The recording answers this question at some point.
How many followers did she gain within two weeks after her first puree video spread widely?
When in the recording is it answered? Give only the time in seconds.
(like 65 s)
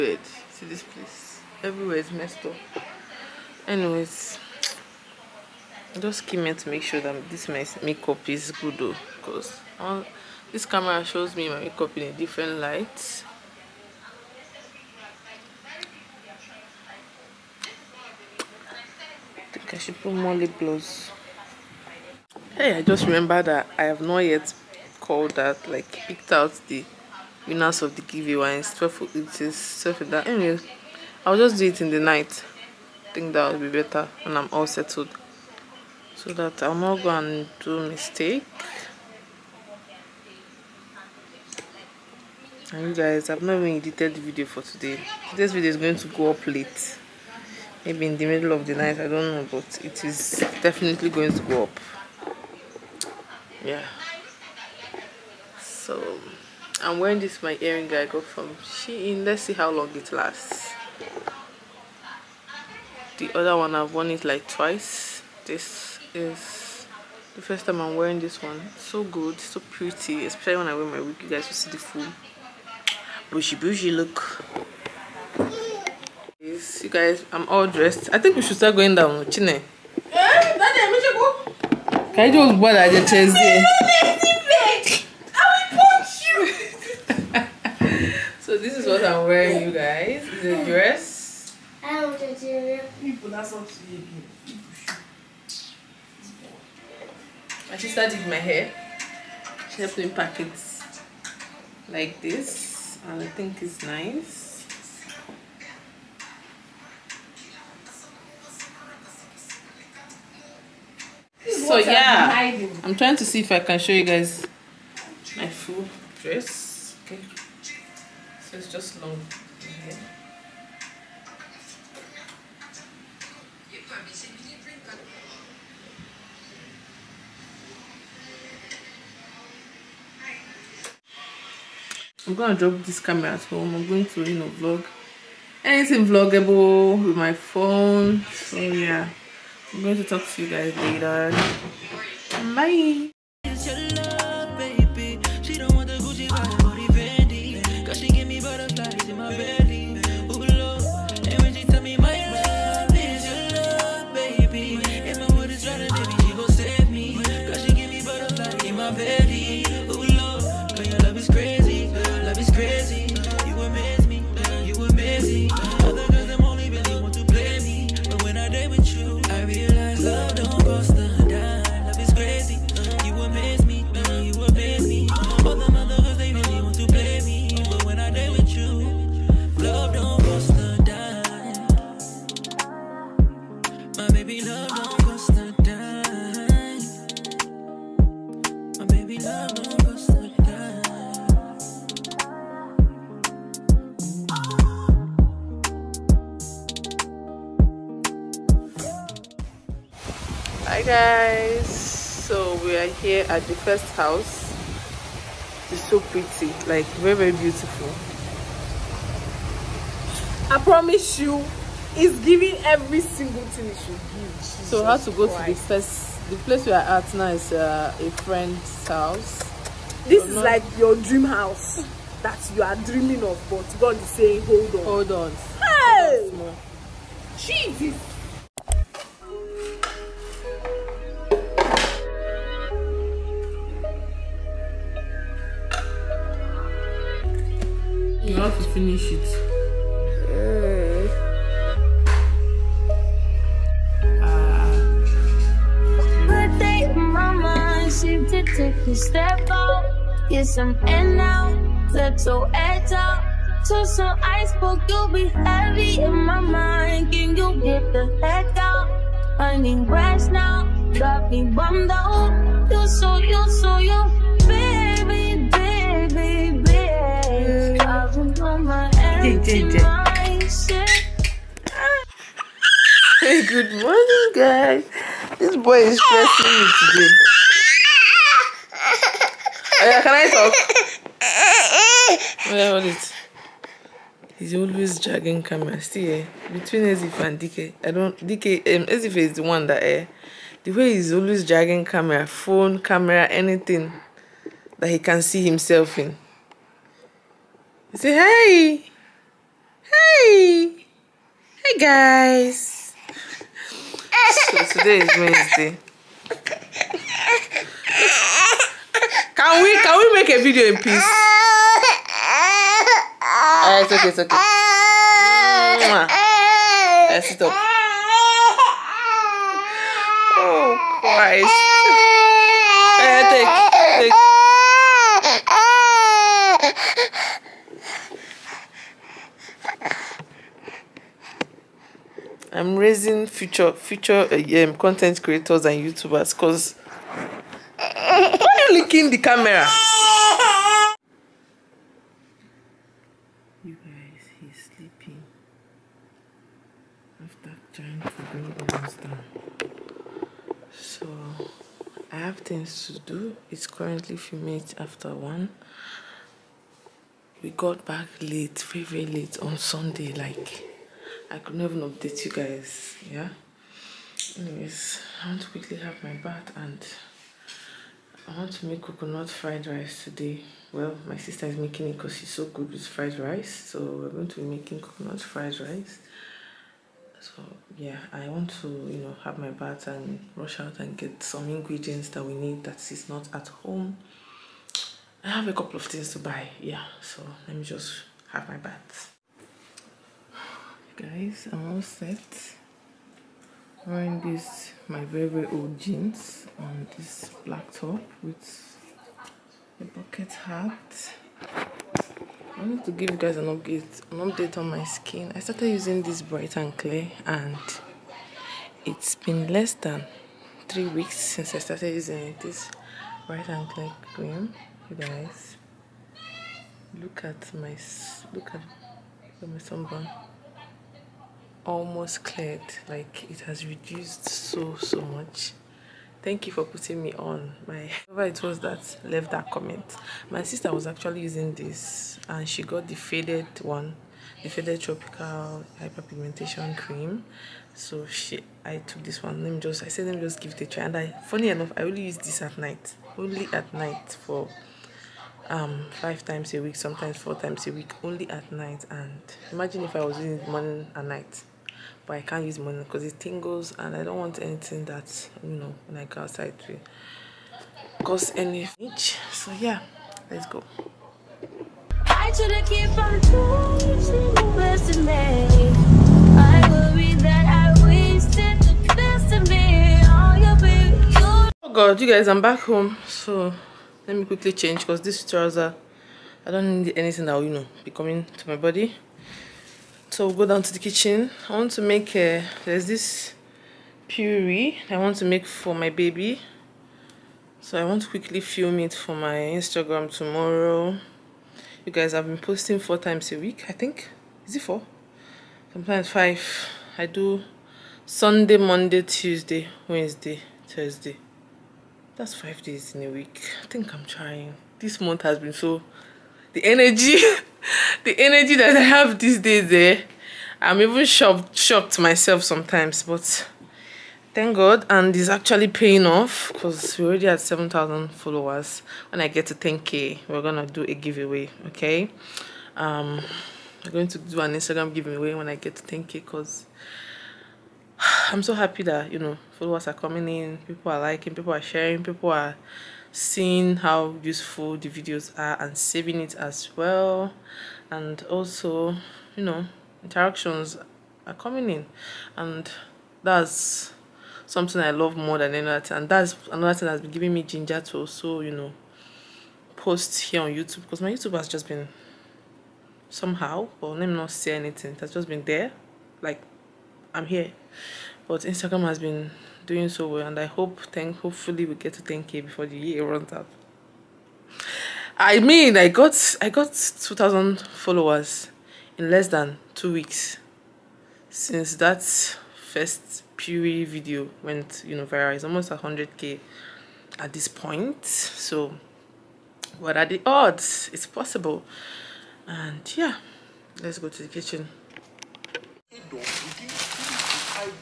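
566 s.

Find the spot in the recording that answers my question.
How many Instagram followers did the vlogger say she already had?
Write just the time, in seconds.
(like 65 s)
517 s.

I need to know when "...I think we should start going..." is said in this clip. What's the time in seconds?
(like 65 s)
78 s.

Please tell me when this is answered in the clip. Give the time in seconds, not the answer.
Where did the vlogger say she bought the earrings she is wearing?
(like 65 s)
58 s.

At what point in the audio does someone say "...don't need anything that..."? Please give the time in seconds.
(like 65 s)
476 s.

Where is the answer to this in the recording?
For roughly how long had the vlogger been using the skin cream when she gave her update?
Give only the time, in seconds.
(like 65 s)
409 s.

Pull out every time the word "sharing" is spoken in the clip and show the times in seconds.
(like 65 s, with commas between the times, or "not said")
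531 s.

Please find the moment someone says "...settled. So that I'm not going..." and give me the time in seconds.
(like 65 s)
34 s.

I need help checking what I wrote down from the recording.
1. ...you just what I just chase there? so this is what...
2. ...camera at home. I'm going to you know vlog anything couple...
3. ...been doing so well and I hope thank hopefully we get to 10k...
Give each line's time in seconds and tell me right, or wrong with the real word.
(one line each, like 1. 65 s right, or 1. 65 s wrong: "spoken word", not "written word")
1. 82 s right
2. 132 s wrong: "vloggable", not "couple"
3. 558 s right.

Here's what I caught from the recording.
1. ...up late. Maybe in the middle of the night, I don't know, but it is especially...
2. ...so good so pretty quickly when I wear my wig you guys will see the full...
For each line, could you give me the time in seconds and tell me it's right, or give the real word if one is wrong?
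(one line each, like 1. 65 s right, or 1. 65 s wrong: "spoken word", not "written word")
1. 46 s wrong: "definitely", not "especially"
2. 68 s wrong: "especially", not "quickly".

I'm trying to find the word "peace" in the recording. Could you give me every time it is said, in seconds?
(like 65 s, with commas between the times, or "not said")
310 s.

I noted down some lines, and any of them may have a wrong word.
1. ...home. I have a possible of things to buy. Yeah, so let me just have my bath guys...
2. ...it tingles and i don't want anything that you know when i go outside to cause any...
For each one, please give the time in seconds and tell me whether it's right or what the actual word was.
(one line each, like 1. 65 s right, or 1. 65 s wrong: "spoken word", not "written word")
1. 383 s wrong: "couple", not "possible"
2. 453 s right.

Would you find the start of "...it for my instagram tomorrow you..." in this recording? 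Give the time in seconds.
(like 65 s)
488 s.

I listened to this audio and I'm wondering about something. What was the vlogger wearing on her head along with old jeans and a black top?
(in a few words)
A bucket hat.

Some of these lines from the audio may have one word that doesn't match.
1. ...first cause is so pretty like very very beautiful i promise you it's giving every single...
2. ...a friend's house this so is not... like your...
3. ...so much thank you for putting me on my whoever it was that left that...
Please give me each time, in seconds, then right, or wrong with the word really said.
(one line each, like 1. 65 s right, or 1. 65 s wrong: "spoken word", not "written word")
1. 203 s wrong: "house", not "cause"
2. 217 s right
3. 424 s right.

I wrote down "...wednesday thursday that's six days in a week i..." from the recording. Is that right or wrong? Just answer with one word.
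wrong.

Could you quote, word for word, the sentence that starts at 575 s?
It's almost 100k at this point.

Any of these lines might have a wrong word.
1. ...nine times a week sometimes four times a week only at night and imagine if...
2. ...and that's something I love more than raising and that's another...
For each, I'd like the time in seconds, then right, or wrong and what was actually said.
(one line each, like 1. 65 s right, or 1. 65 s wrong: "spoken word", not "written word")
1. 445 s wrong: "five", not "nine"
2. 542 s wrong: "anything", not "raising".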